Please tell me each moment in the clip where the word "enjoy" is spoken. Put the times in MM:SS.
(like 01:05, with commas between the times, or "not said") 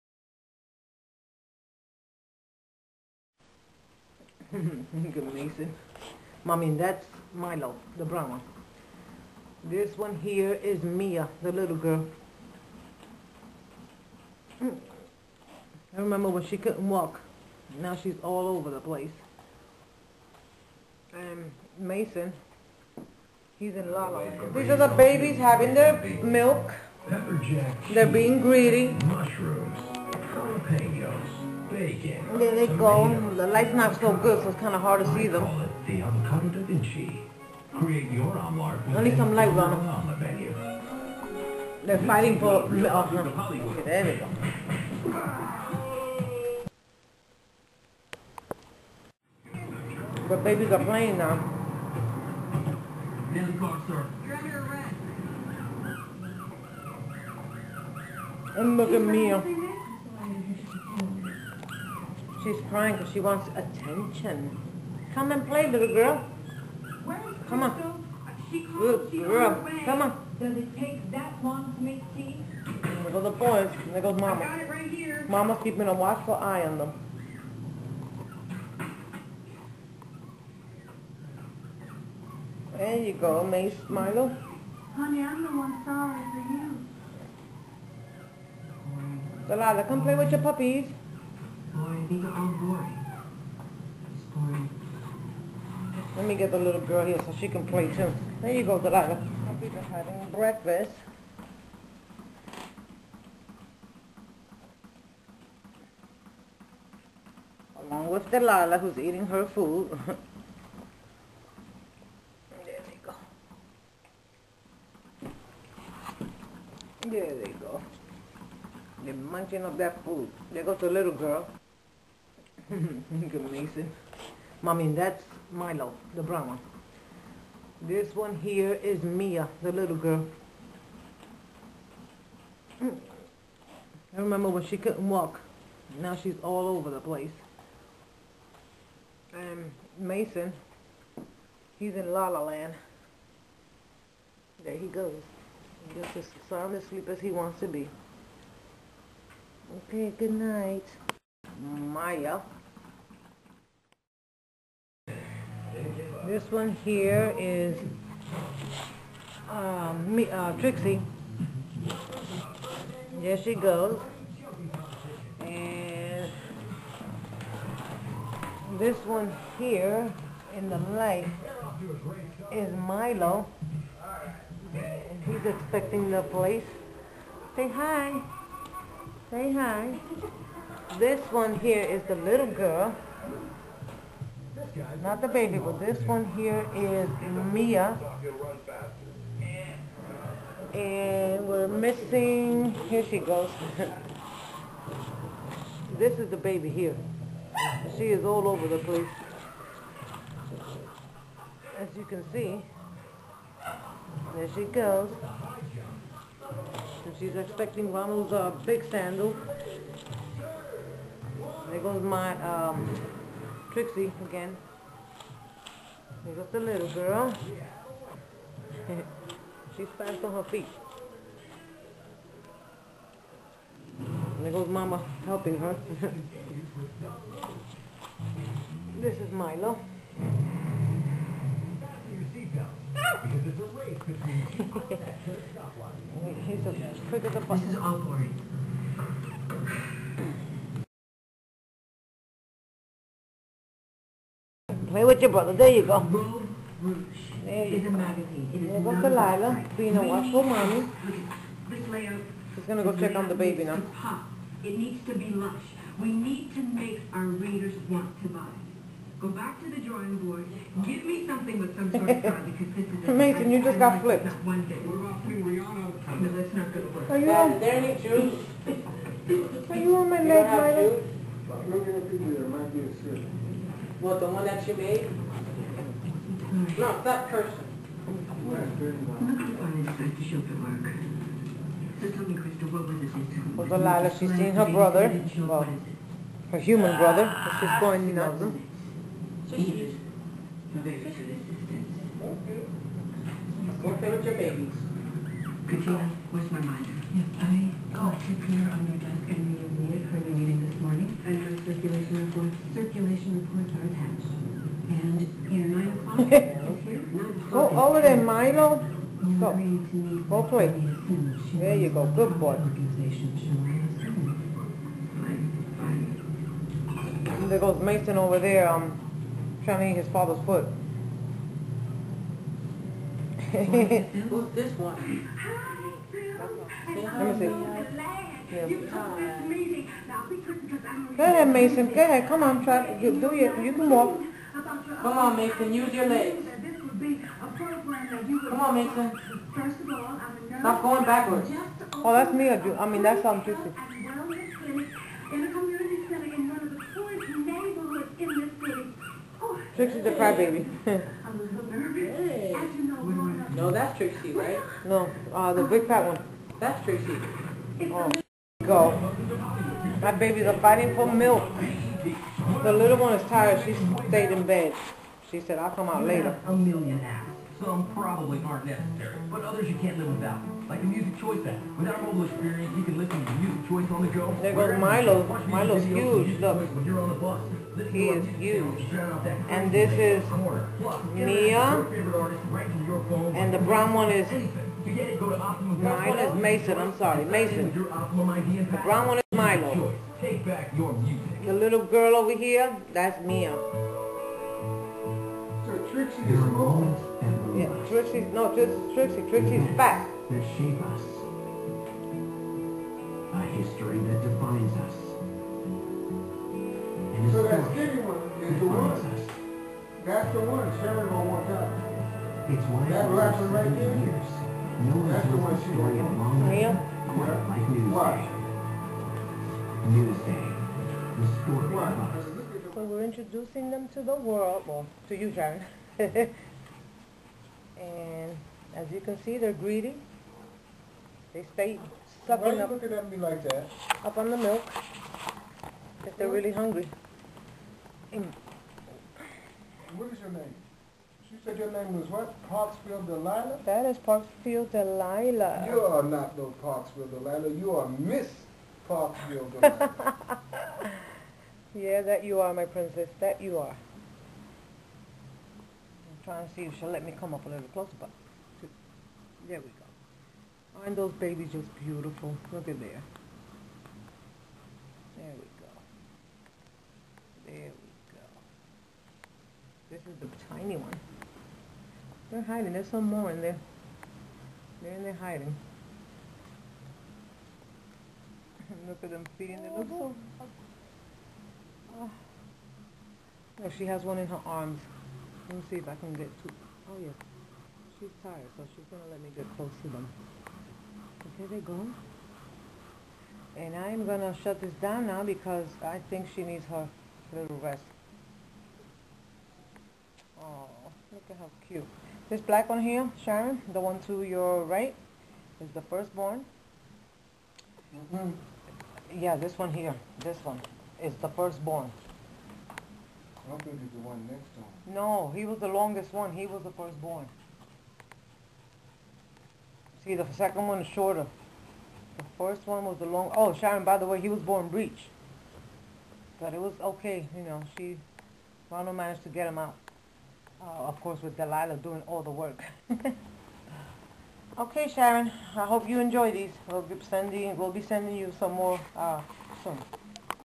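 08:55.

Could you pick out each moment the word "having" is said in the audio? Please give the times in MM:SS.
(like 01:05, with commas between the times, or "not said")
00:25, 01:39.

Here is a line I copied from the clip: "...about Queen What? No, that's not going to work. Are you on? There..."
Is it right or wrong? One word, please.
wrong.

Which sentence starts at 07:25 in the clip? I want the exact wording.
You are not no Parksville Delilah.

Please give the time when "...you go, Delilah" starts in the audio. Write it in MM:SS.
01:38.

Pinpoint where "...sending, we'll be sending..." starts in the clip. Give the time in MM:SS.
08:57.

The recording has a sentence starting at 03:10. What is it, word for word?
And we're missing, here she goes.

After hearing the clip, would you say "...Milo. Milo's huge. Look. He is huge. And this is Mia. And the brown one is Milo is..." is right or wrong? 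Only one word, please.
right.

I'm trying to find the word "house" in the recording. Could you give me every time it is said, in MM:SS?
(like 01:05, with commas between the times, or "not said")
not said.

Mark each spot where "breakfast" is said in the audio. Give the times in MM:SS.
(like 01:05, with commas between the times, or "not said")
01:40.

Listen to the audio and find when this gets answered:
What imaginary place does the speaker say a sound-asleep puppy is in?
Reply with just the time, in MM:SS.
02:22.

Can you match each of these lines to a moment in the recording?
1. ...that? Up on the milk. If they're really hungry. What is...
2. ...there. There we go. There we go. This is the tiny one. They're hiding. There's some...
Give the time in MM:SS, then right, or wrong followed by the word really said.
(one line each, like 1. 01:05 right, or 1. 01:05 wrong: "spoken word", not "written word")
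1. 07:13 right
2. 07:42 right.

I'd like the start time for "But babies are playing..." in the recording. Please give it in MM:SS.
00:50.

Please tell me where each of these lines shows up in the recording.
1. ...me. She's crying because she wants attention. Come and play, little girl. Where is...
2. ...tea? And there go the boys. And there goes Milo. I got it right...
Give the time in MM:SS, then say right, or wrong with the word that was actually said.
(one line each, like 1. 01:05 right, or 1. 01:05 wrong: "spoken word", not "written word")
1. 00:59 right
2. 01:12 wrong: "Mama", not "Milo".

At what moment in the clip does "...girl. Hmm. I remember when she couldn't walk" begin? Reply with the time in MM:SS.
00:11.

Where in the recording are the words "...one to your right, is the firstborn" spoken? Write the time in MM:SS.
08:23.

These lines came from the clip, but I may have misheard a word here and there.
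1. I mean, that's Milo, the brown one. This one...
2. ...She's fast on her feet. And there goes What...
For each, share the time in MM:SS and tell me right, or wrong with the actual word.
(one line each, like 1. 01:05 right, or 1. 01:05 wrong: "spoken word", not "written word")
1. 02:04 right
2. 03:39 wrong: "Mama", not "What".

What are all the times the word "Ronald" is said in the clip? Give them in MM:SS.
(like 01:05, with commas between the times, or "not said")
03:27, 08:48.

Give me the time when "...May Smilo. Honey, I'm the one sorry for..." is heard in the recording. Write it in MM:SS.
01:23.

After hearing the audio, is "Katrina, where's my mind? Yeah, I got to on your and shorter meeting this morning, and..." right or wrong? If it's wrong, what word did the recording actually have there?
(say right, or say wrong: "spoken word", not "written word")
wrong: "further", not "shorter".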